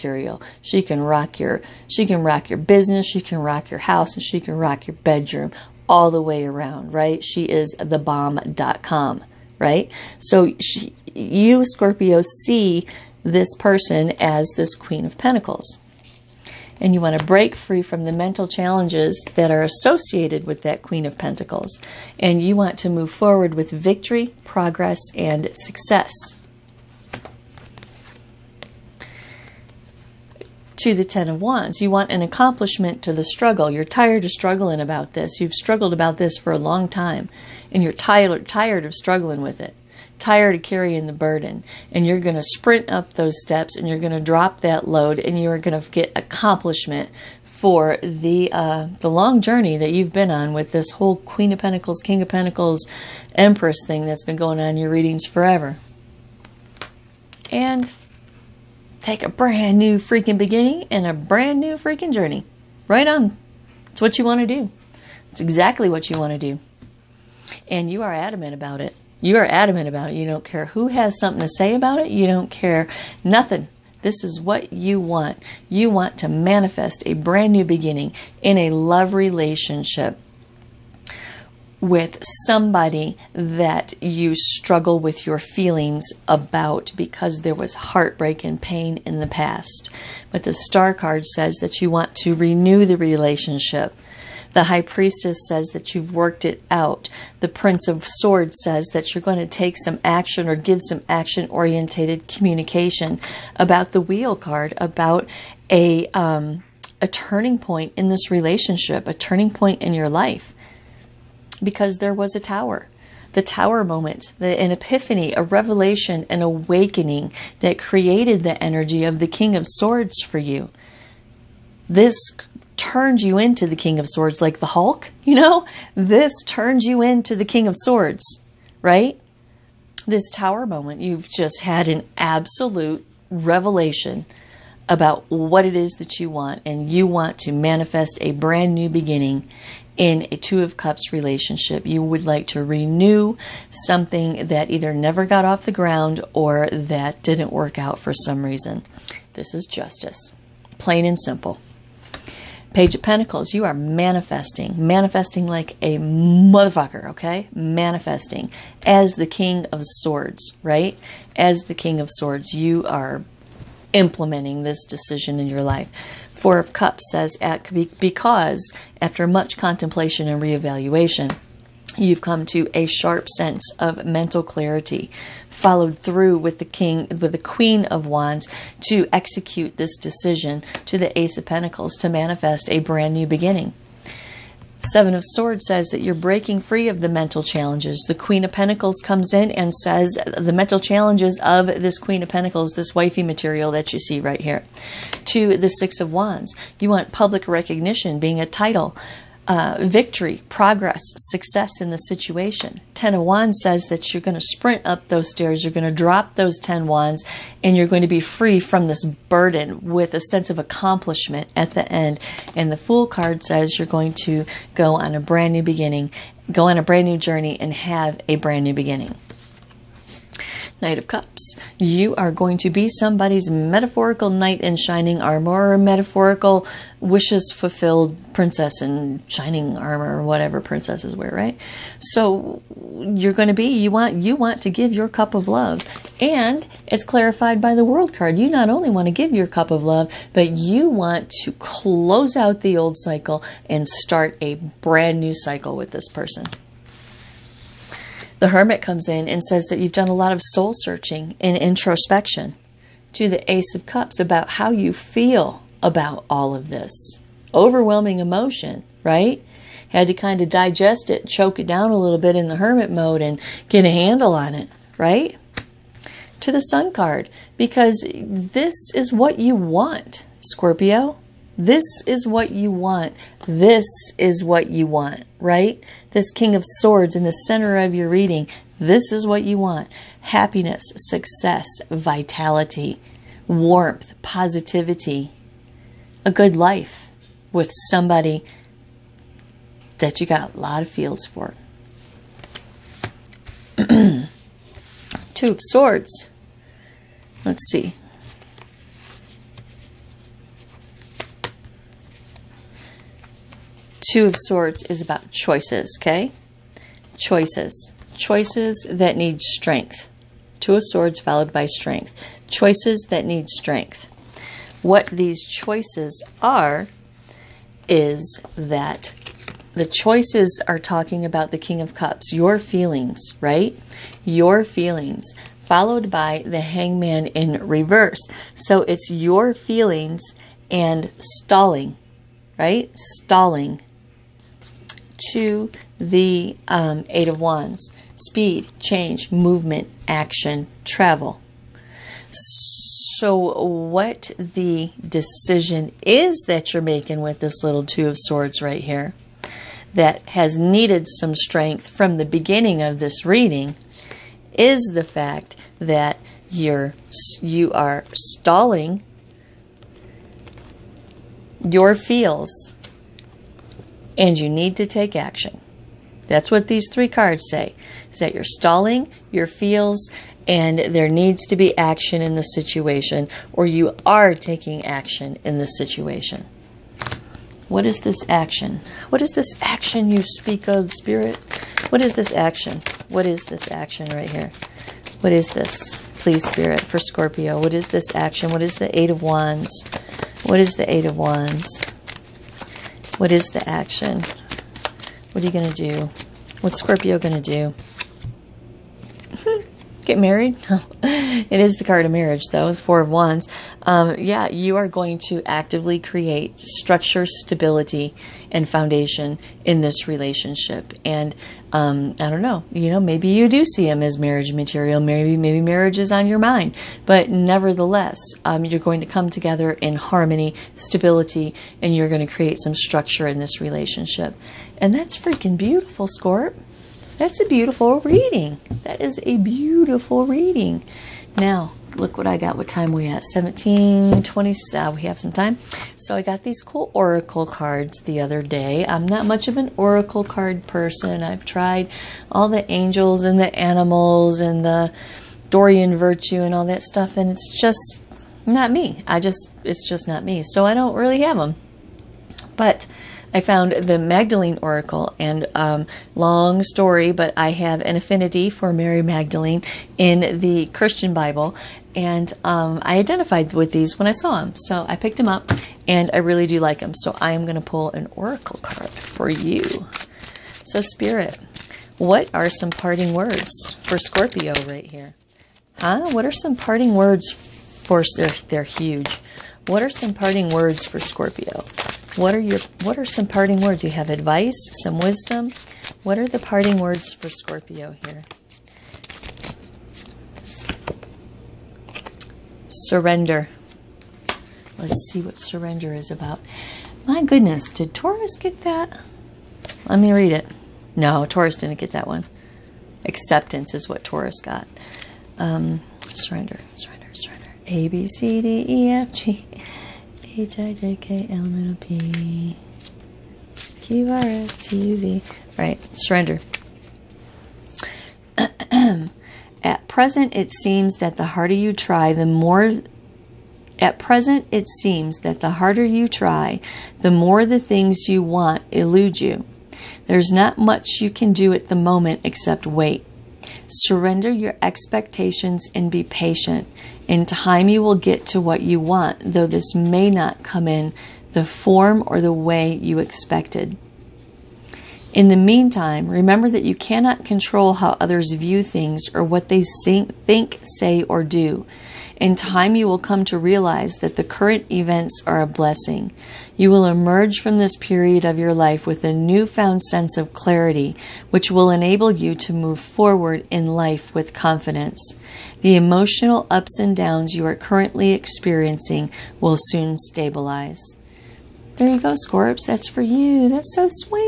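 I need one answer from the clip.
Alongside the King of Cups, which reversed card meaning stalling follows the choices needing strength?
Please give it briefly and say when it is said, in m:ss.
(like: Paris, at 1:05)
Hangman, at 5:26.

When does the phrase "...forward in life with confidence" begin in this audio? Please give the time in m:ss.
9:22.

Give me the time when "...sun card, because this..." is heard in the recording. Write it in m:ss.
4:26.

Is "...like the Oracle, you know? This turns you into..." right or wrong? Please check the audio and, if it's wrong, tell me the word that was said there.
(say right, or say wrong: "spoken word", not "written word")
wrong: "Hulk", not "Oracle".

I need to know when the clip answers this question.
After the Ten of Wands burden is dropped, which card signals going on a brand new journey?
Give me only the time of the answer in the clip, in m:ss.
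3:32.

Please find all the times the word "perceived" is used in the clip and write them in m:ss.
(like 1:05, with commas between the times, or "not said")
not said.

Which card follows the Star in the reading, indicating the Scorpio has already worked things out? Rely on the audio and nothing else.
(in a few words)
High Priestess.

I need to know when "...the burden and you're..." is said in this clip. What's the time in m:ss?
0:41.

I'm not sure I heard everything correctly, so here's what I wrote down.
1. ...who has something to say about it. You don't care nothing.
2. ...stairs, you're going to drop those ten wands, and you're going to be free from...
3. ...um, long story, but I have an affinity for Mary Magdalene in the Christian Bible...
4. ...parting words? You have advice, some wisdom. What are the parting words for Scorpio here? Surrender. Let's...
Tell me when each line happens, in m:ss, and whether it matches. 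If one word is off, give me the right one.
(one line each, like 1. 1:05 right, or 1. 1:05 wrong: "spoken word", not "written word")
1. 1:10 right
2. 3:25 right
3. 7:35 right
4. 8:03 right.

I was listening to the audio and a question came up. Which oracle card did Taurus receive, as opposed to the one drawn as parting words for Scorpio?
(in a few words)
Acceptance.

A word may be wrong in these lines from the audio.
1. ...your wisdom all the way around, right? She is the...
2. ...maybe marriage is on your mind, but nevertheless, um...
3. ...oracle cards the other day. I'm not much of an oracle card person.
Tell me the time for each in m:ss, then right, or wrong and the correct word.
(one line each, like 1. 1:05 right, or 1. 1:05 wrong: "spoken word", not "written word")
1. 0:04 wrong: "bedroom", not "wisdom"
2. 6:55 right
3. 7:16 right.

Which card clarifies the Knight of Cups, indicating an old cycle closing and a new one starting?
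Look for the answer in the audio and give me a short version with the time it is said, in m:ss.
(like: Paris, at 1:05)
The World, at 3:57.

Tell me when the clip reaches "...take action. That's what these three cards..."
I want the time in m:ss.
6:04.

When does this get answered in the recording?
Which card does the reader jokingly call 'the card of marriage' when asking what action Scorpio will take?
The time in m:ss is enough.
6:42.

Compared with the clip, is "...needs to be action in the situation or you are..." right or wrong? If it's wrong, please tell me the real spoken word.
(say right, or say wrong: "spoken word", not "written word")
right.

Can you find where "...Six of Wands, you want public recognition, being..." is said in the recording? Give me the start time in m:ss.
3:15.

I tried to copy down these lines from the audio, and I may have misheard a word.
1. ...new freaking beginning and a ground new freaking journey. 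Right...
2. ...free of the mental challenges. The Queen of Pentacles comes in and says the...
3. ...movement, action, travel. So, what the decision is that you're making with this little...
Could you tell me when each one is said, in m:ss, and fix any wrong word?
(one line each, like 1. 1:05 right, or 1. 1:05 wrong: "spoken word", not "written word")
1. 0:59 wrong: "brand", not "ground"
2. 3:06 right
3. 5:39 right.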